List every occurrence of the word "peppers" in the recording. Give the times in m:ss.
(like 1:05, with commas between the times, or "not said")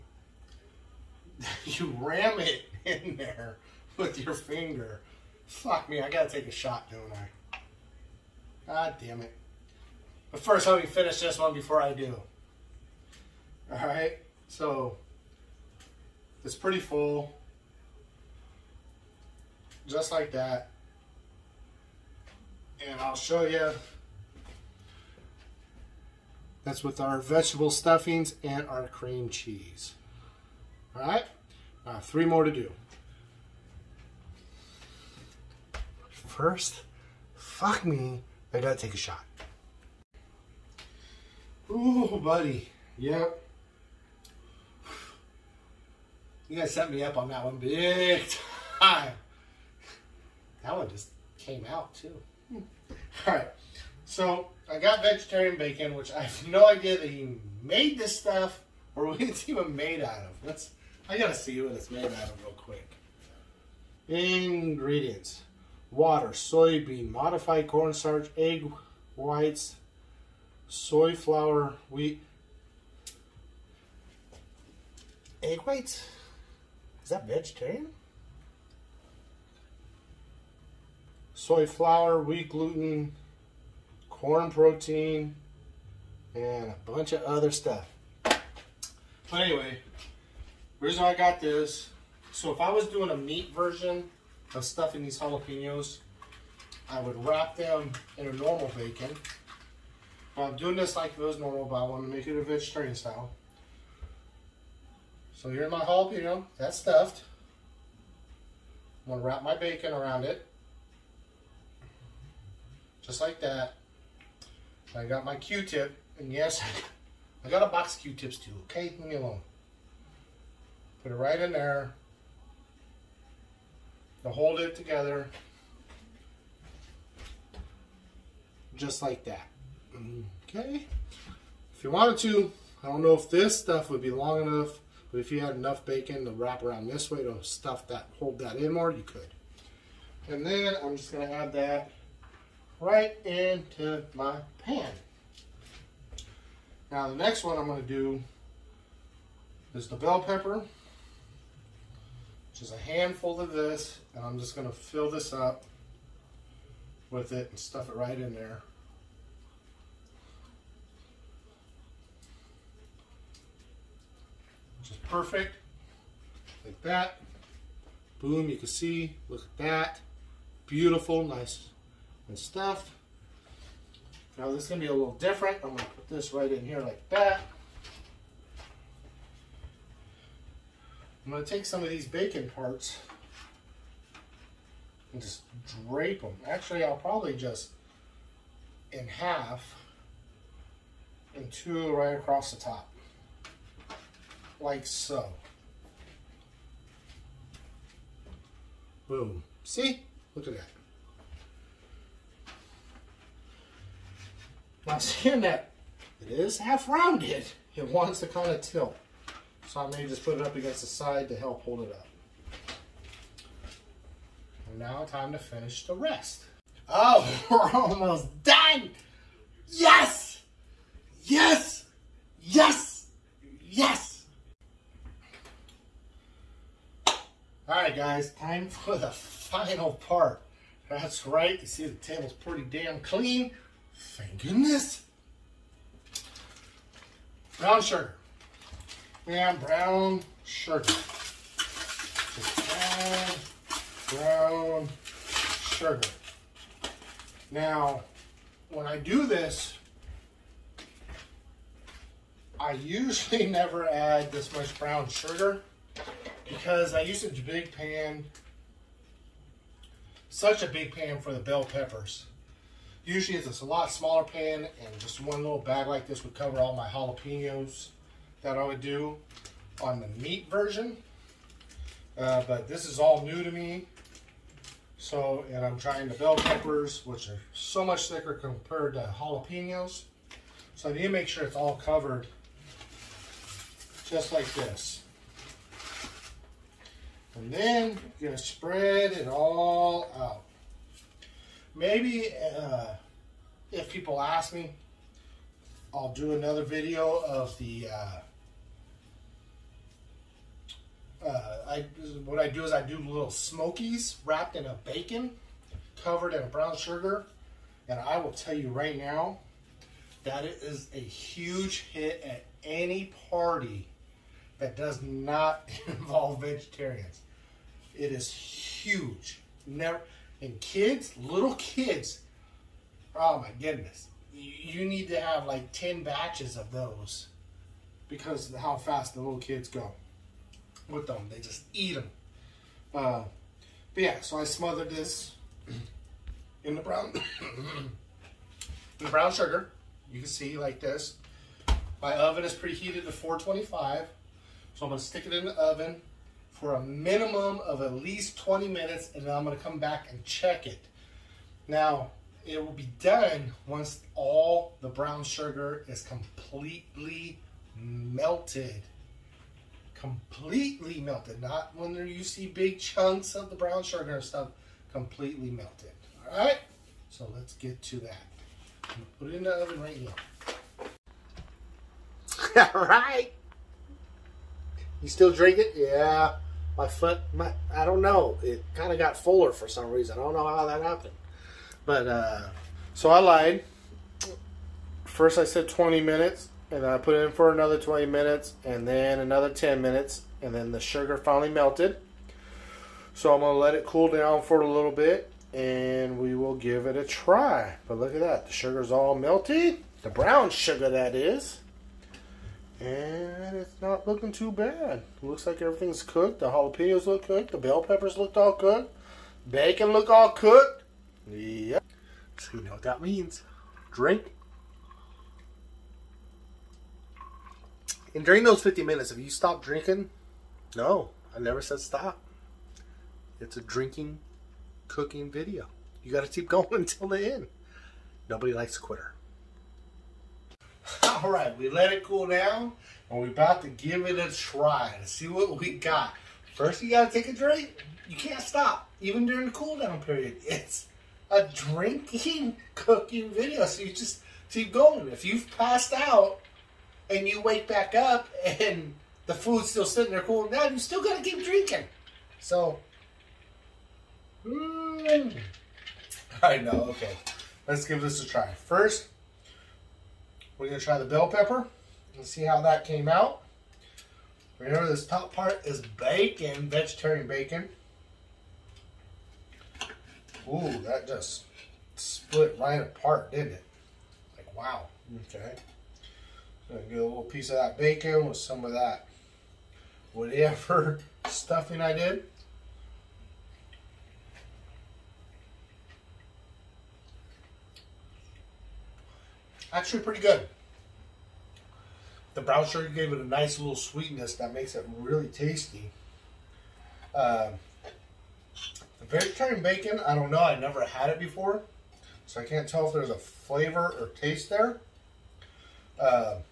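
2:30, 4:21, 4:36, 6:47, 7:41.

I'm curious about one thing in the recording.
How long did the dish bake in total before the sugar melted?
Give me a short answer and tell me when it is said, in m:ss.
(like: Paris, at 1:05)
50 minutes, at 6:58.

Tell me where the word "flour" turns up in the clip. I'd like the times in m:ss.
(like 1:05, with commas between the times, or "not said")
1:11, 1:21.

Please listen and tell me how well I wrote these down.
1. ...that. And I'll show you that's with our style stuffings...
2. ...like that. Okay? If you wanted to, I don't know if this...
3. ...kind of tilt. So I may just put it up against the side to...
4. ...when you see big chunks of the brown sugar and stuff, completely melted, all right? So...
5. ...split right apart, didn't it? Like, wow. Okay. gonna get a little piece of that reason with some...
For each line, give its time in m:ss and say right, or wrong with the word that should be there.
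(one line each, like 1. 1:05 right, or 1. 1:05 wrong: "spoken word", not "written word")
1. 0:20 wrong: "vegetable", not "style"
2. 2:09 right
3. 3:28 right
4. 6:01 right
5. 7:51 wrong: "bacon", not "reason".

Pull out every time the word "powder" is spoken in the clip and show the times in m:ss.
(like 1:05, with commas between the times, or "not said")
not said.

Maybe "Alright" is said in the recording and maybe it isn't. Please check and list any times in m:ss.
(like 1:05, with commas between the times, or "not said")
0:13, 3:47.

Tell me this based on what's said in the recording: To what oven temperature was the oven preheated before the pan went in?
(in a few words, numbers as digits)
425.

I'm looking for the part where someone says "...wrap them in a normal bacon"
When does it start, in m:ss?
1:37.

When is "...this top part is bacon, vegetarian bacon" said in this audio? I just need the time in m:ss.
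7:44.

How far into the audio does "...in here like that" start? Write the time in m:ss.
2:56.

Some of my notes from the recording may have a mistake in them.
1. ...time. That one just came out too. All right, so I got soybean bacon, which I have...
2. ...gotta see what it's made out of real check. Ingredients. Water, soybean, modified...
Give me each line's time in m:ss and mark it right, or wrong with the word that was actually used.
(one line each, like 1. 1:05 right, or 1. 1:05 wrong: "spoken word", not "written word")
1. 0:48 wrong: "vegetarian", not "soybean"
2. 1:01 wrong: "quick", not "check".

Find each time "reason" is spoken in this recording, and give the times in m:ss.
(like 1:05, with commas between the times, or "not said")
1:30, 6:19.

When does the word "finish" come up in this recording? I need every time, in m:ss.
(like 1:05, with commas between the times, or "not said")
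0:10, 3:35.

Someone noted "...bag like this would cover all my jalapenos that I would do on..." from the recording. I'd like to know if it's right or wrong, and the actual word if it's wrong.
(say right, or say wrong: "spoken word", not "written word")
right.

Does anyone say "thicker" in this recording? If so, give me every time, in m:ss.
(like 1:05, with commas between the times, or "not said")
4:38.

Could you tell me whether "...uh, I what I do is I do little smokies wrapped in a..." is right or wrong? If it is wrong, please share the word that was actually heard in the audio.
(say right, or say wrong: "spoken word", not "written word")
right.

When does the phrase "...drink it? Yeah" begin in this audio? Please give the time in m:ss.
6:15.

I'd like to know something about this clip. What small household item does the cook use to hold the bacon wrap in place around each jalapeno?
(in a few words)
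Q-tip.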